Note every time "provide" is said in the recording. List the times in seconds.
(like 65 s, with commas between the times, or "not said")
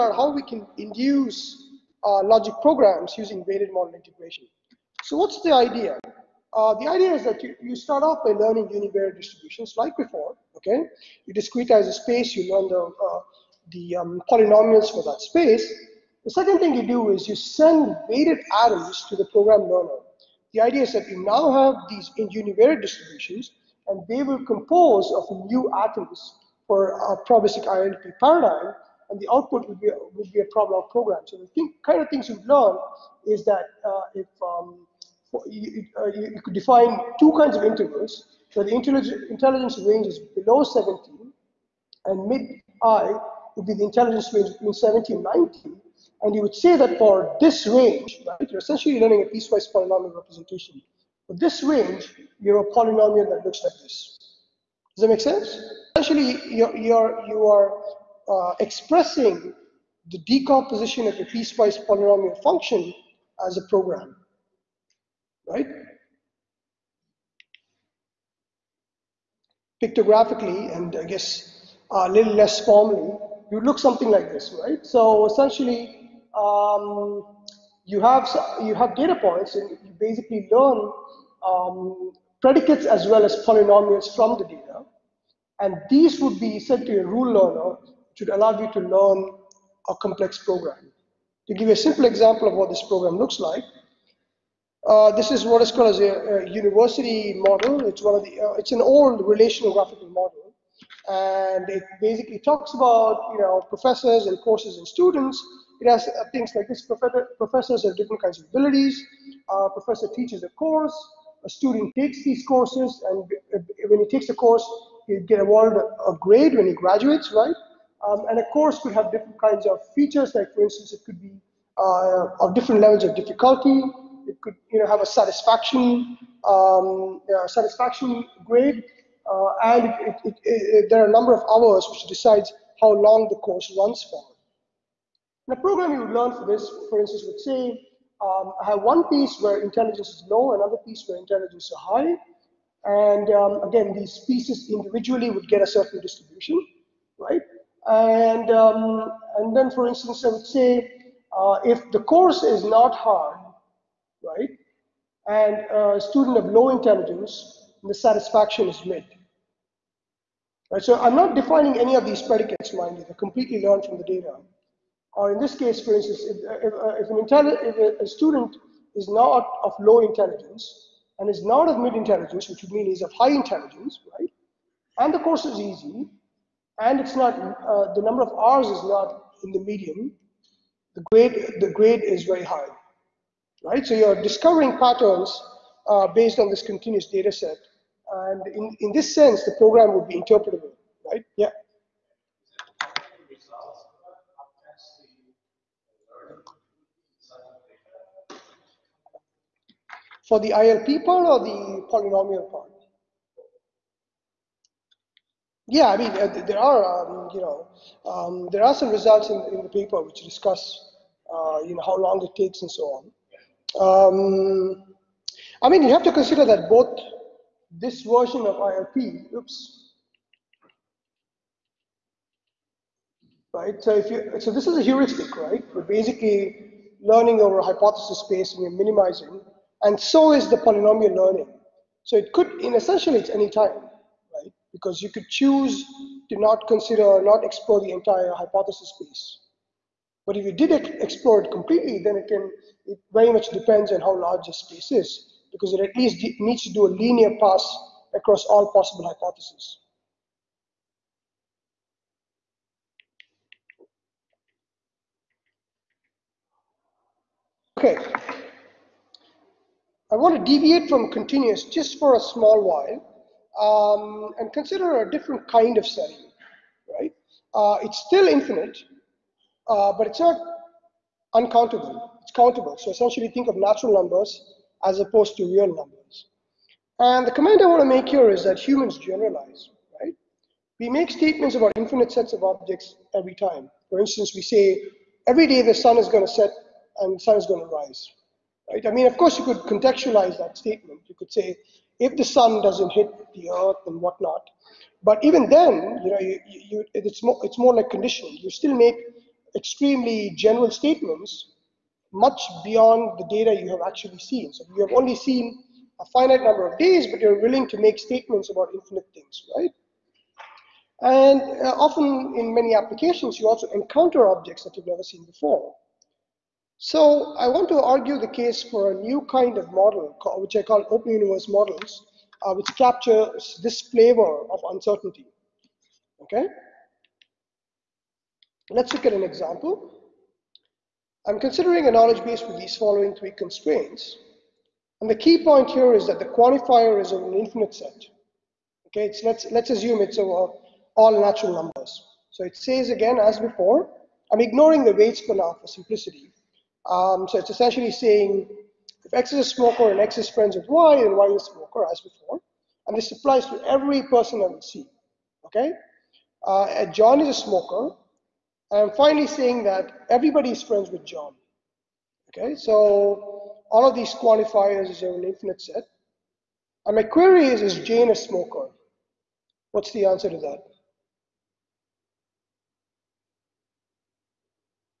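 not said.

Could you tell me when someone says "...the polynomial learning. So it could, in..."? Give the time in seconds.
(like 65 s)
230 s.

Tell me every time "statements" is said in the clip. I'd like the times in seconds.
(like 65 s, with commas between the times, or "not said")
281 s, 290 s, 300 s, 307 s.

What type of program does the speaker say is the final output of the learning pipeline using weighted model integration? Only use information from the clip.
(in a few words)
ProbLog program.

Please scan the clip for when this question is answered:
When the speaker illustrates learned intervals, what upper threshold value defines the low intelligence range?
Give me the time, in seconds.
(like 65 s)
40 s.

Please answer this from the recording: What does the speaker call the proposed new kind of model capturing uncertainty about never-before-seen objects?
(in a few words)
open universe models.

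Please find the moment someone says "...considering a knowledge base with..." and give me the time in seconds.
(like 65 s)
331 s.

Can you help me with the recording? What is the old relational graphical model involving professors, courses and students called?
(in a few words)
university model.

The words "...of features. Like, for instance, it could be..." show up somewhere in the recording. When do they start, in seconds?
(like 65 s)
119 s.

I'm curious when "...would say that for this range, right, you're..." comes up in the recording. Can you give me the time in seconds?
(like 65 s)
46 s.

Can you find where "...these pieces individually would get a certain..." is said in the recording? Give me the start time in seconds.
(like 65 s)
143 s.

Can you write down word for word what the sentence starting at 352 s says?
And this applies to every person I will see.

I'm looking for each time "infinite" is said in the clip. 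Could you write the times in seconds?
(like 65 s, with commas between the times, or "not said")
268 s, 281 s, 308 s, 337 s, 365 s.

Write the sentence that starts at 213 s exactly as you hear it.
Um, I mean, you have to consider that both this version of ILP, oops, right?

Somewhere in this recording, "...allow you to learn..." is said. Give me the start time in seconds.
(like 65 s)
88 s.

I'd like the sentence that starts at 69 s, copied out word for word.
Pictographically, and I guess a little less formally, you look something like this, right?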